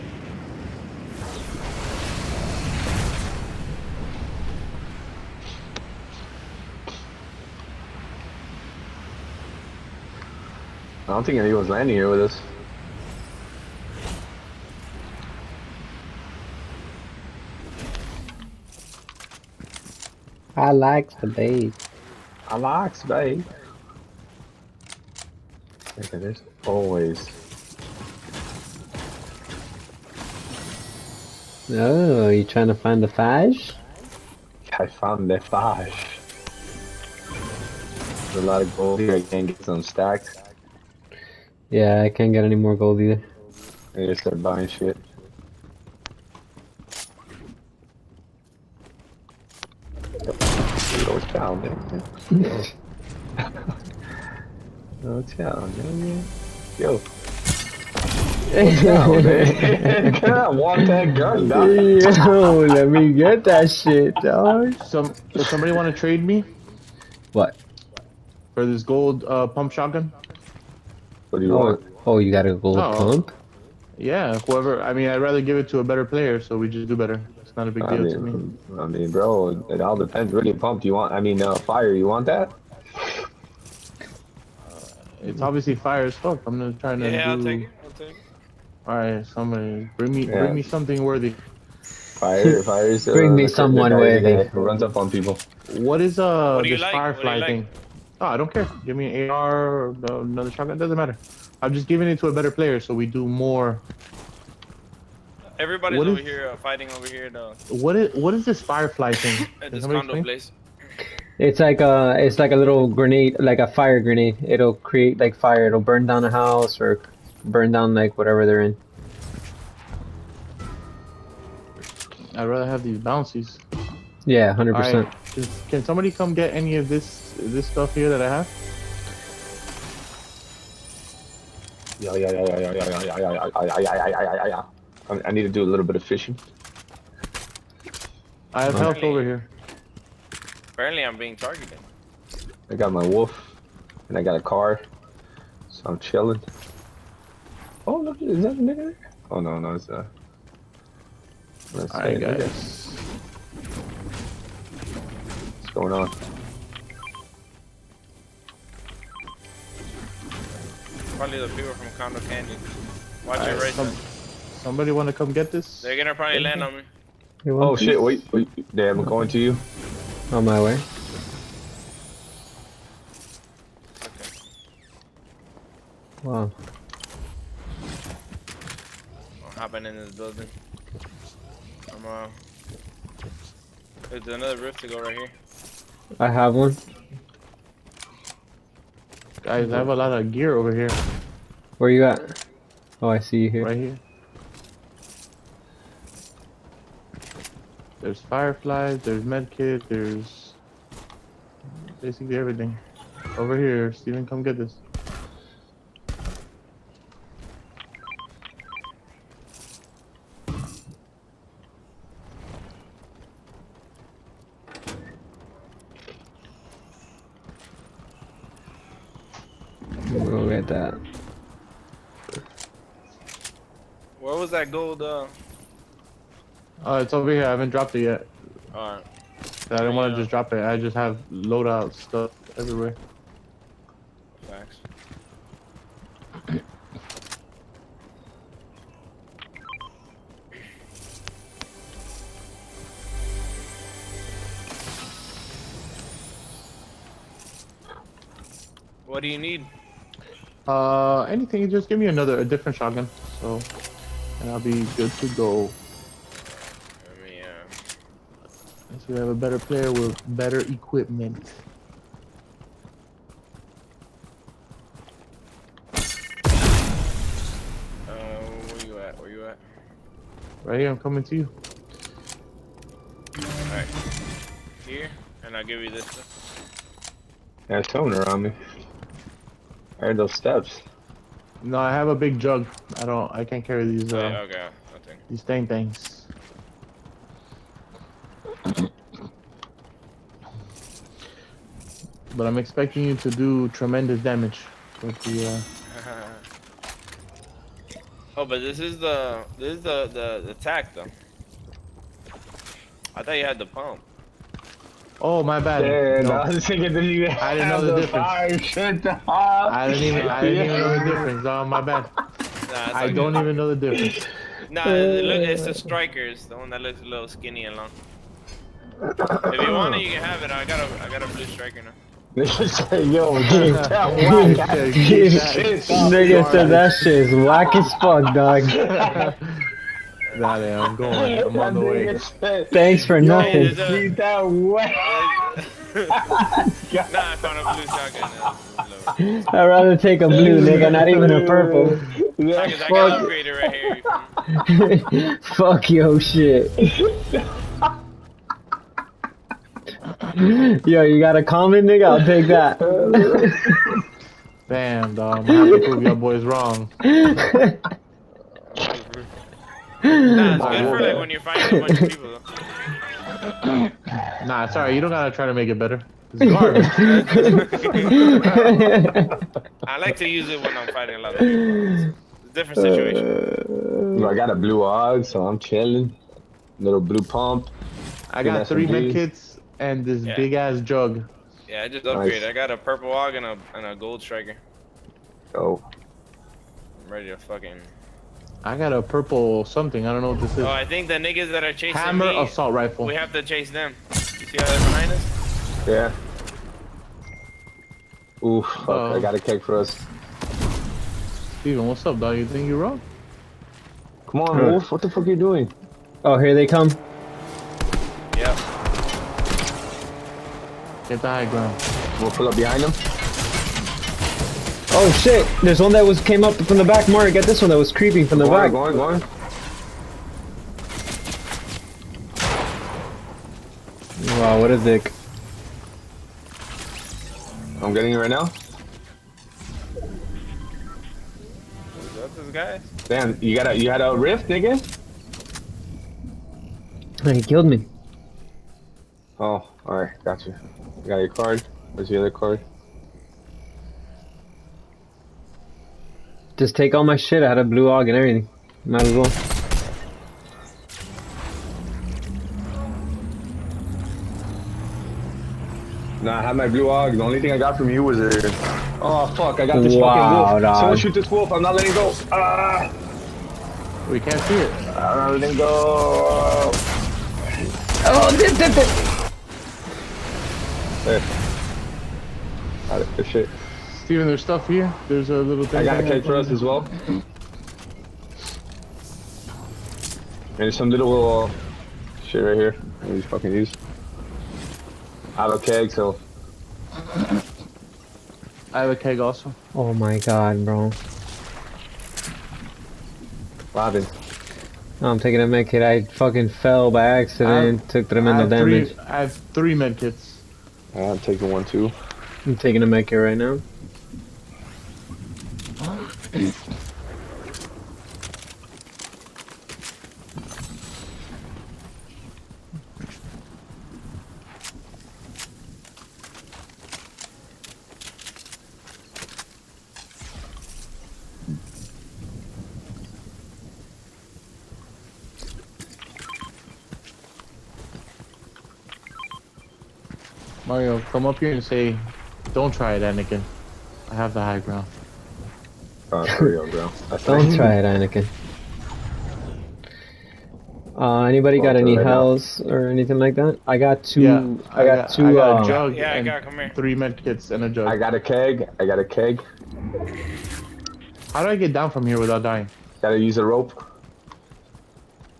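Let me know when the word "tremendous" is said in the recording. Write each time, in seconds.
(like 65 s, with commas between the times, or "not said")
293 s, 498 s.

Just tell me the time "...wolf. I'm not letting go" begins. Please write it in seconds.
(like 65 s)
461 s.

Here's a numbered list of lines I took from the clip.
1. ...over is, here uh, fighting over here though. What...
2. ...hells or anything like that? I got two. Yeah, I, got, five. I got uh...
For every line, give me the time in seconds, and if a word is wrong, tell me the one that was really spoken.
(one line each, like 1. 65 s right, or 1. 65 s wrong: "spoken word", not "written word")
1. 106 s right
2. 541 s wrong: "two", not "five".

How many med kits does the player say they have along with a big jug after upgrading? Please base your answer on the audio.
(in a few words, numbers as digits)
3.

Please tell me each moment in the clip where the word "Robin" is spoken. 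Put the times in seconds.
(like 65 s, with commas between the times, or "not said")
493 s.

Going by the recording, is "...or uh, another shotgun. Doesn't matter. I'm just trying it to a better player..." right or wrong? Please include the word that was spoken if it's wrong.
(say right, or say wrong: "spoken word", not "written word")
wrong: "giving", not "trying".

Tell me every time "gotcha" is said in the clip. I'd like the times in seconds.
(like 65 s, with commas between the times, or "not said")
440 s.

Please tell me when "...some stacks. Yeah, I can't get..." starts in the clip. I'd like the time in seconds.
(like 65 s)
39 s.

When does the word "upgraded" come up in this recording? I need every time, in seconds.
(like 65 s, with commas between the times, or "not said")
343 s, 382 s.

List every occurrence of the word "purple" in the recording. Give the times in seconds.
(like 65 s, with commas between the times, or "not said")
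341 s, 382 s, 389 s.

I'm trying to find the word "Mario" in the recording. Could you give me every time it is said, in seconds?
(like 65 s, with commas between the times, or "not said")
417 s, 530 s.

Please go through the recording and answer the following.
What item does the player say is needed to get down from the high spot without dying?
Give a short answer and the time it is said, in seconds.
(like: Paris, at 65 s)
A rope, at 553 s.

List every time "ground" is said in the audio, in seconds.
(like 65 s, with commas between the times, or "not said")
411 s, 534 s.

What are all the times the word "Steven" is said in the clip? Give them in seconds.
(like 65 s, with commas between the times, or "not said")
203 s, 401 s, 474 s.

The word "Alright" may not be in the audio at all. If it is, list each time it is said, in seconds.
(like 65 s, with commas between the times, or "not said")
151 s, 228 s.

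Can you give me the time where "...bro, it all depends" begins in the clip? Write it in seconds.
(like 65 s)
79 s.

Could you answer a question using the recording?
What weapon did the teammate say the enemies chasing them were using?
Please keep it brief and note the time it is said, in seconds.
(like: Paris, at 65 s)
Assault rifle, at 391 s.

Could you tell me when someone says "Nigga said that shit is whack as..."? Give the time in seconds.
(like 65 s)
326 s.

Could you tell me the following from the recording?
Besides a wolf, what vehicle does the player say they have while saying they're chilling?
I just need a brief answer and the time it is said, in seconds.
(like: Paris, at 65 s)
A car, at 144 s.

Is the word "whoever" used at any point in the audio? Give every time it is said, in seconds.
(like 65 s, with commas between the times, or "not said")
74 s.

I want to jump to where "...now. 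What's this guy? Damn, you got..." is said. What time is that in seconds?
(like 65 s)
428 s.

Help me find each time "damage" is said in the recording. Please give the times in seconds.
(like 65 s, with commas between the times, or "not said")
294 s, 498 s.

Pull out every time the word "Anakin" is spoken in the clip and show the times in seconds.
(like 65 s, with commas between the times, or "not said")
533 s, 537 s.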